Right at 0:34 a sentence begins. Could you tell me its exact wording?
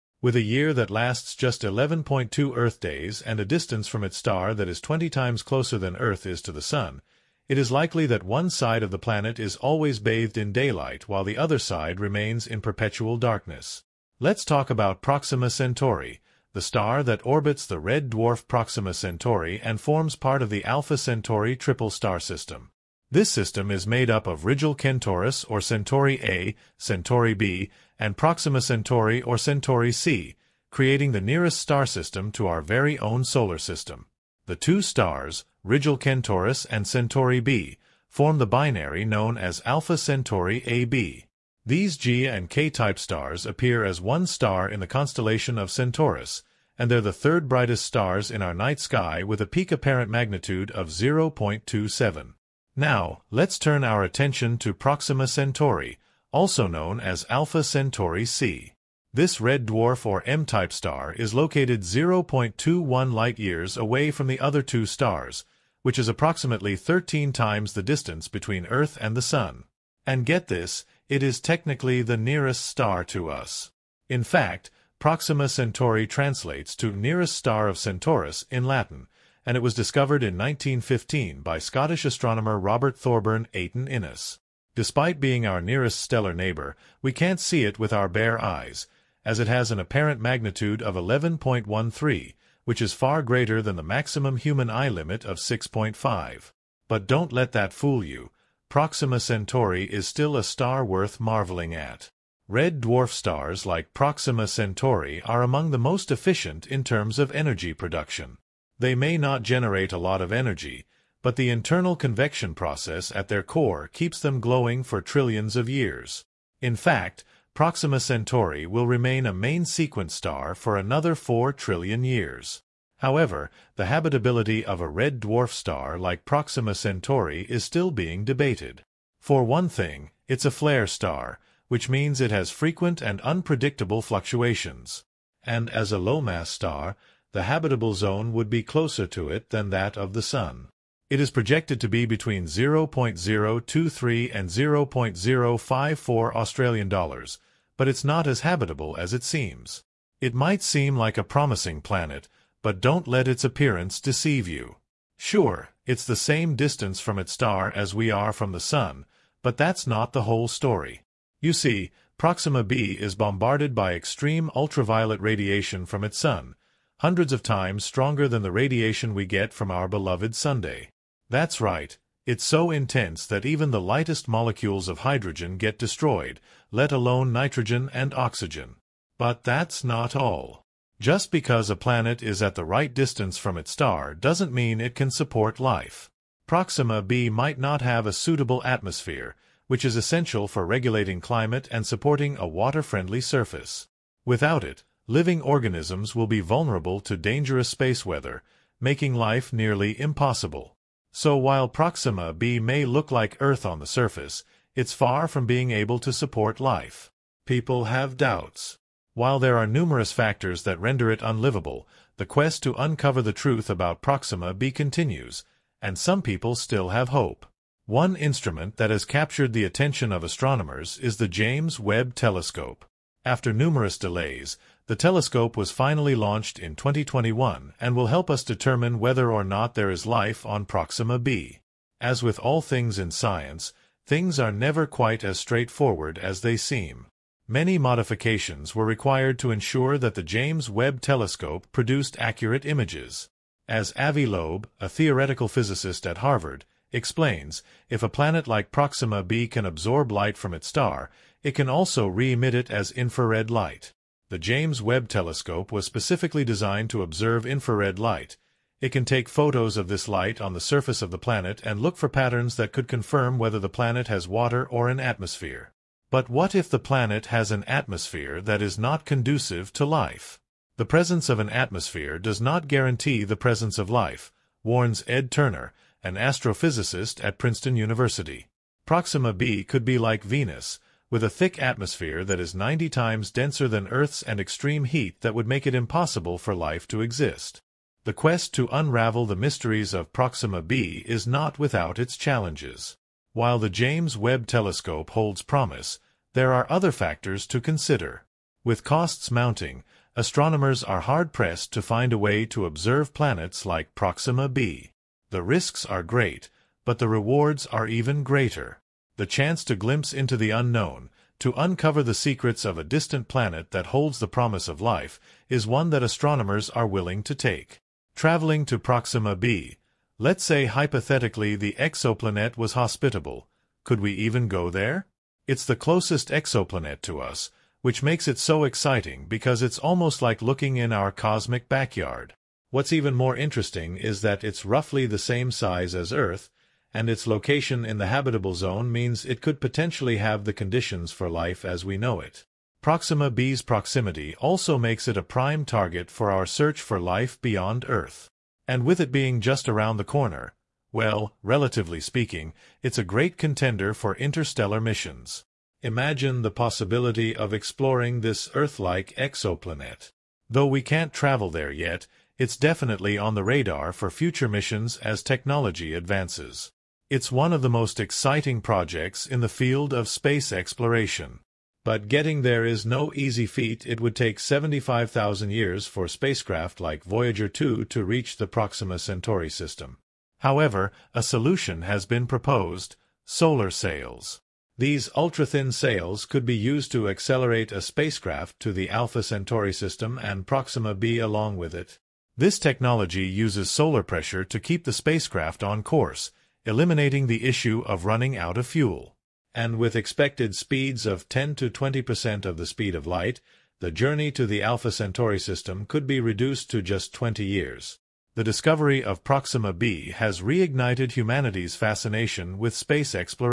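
The two stars, Rigil Kentaurus and Centauri B, form the binary known as Alpha Centauri AB.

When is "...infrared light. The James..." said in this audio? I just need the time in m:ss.
4:12.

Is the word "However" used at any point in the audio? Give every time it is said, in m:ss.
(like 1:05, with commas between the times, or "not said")
2:02, 6:20.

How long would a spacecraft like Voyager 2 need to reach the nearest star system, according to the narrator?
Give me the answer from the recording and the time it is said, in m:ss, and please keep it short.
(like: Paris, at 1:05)
75,000 years, at 6:14.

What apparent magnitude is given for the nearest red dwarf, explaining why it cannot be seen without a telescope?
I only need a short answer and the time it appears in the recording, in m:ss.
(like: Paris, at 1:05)
11.13, at 1:30.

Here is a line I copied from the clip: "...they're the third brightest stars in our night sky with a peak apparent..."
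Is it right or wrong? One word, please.
right.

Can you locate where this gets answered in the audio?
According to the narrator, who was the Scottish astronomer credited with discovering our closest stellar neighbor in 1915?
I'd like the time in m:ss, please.
1:22.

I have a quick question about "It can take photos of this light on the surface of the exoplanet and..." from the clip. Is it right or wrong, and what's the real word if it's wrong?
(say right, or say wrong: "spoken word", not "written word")
wrong: "planet", not "exoplanet".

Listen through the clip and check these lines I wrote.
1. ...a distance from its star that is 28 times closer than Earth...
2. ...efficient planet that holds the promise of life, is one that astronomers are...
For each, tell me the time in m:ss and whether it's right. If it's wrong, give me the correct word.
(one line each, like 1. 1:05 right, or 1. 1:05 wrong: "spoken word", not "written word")
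1. 0:03 wrong: "20", not "28"
2. 5:12 wrong: "distant", not "efficient".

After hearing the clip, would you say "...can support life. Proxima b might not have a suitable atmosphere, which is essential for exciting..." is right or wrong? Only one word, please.
wrong.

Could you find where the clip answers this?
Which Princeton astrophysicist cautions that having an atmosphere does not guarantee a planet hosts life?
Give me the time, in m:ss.
4:35.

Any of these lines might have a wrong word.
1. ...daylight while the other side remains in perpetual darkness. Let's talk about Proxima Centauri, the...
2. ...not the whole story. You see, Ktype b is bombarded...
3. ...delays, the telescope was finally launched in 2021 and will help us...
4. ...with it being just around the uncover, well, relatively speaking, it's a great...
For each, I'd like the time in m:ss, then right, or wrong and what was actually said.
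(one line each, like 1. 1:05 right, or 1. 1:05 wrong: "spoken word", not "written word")
1. 0:10 right
2. 2:39 wrong: "Proxima", not "Ktype"
3. 3:43 right
4. 5:48 wrong: "corner", not "uncover".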